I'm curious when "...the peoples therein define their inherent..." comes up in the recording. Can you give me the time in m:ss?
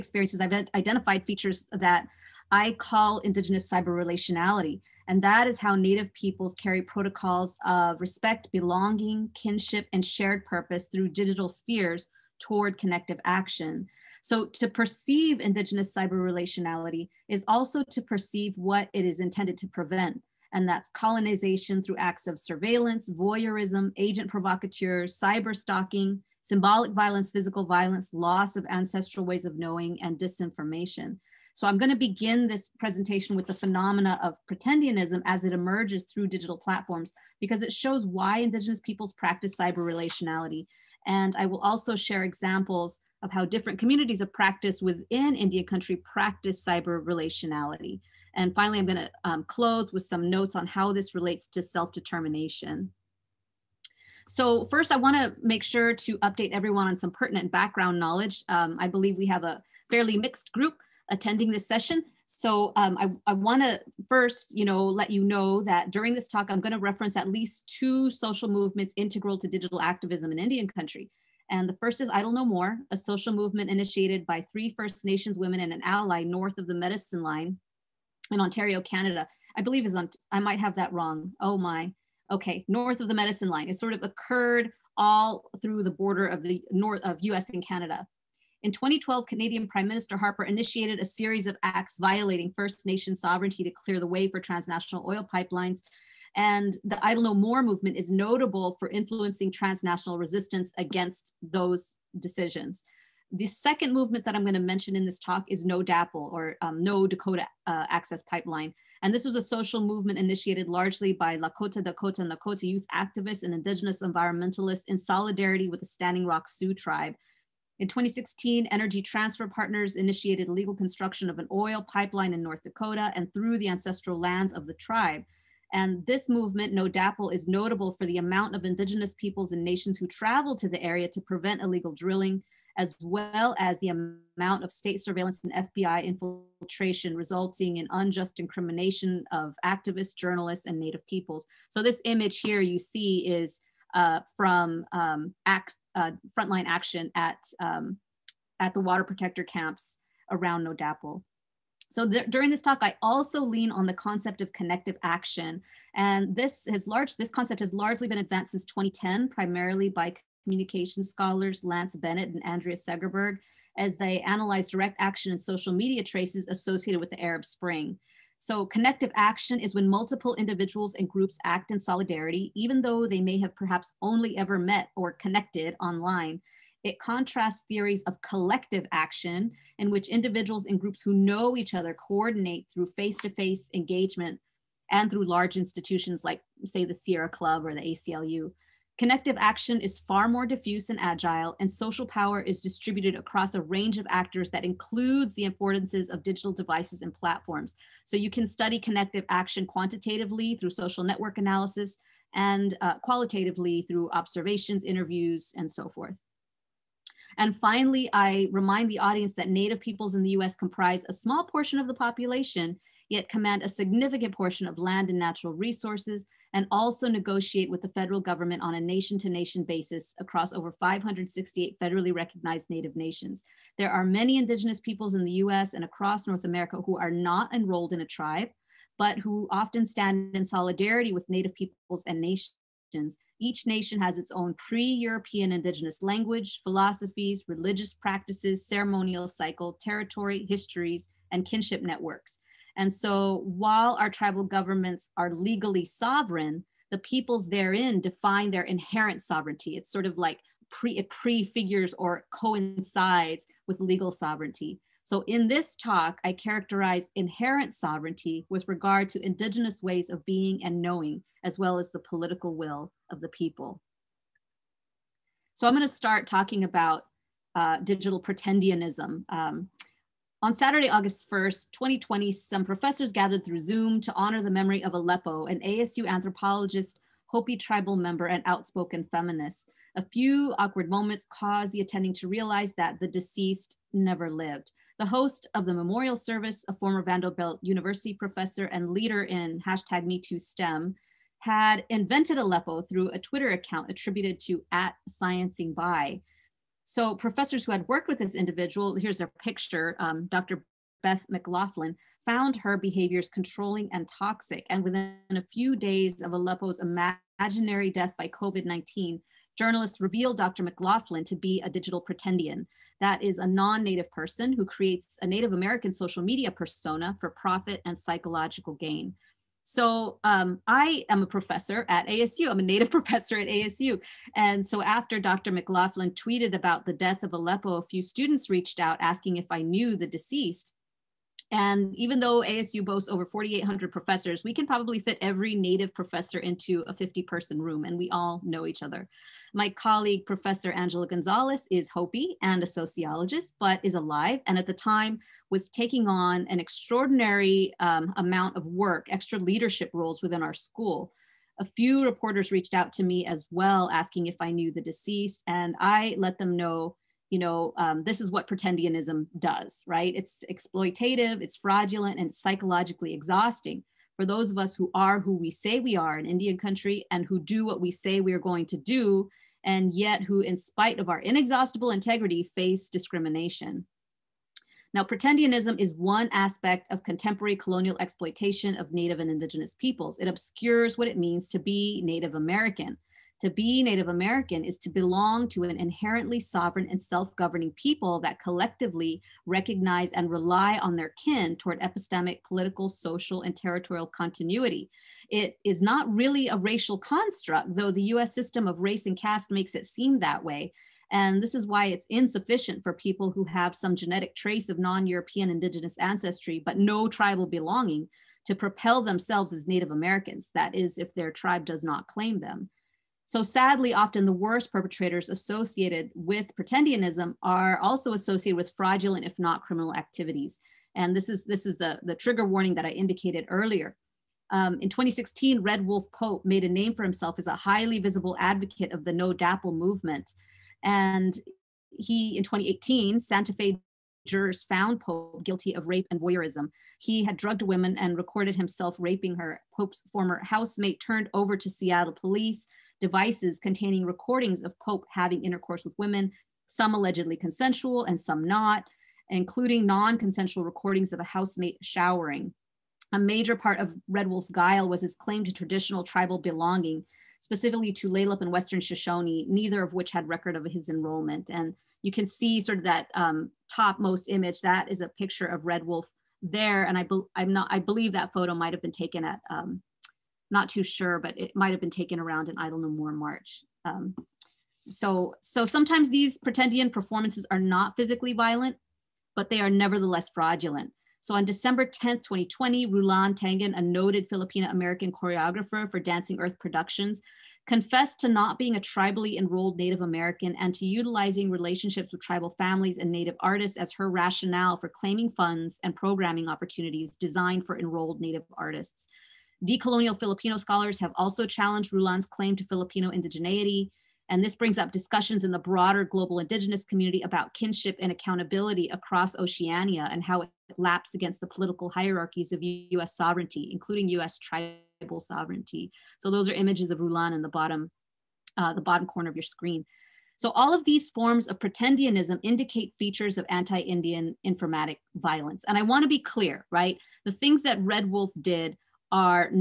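4:06.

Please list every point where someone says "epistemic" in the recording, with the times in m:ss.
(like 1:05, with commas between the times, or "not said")
6:31.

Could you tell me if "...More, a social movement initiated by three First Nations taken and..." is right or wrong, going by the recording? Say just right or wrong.
wrong.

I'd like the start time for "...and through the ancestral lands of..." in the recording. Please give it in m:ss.
2:03.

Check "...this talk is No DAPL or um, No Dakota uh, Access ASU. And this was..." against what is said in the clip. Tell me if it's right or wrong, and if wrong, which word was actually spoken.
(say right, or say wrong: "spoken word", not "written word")
wrong: "Pipeline", not "ASU".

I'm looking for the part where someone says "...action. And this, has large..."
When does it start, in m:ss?
2:35.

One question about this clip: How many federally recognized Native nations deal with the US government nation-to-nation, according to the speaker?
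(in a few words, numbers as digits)
over 568.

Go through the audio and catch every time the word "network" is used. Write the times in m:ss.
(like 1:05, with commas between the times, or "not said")
3:21, 4:01.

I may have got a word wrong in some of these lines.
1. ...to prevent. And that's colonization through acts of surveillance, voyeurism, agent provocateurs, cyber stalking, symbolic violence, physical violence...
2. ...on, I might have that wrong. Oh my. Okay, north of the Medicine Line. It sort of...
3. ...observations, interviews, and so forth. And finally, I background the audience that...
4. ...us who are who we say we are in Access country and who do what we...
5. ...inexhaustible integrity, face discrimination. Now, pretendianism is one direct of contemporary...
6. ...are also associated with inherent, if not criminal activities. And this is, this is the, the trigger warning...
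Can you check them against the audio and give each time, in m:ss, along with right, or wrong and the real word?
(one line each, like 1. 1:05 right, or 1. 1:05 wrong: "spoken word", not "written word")
1. 0:19 right
2. 1:19 right
3. 3:24 wrong: "remind", not "background"
4. 6:04 wrong: "Indian", not "Access"
5. 6:11 wrong: "aspect", not "direct"
6. 6:57 wrong: "fraudulent", not "inherent".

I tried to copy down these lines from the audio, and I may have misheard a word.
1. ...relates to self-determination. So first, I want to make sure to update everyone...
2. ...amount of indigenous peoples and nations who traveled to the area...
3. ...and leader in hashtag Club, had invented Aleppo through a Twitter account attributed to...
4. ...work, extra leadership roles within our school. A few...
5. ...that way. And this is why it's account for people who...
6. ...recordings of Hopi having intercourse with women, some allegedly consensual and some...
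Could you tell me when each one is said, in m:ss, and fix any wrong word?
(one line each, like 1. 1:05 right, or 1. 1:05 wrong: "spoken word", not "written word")
1. 0:51 right
2. 2:08 right
3. 4:48 wrong: "MeTooSTEM", not "Club"
4. 5:48 right
5. 6:40 wrong: "insufficient", not "account"
6. 7:24 wrong: "Pope", not "Hopi".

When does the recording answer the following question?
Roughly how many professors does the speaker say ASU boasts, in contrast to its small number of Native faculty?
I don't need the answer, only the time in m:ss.
5:33.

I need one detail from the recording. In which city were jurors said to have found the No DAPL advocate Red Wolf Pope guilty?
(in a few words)
Santa Fe.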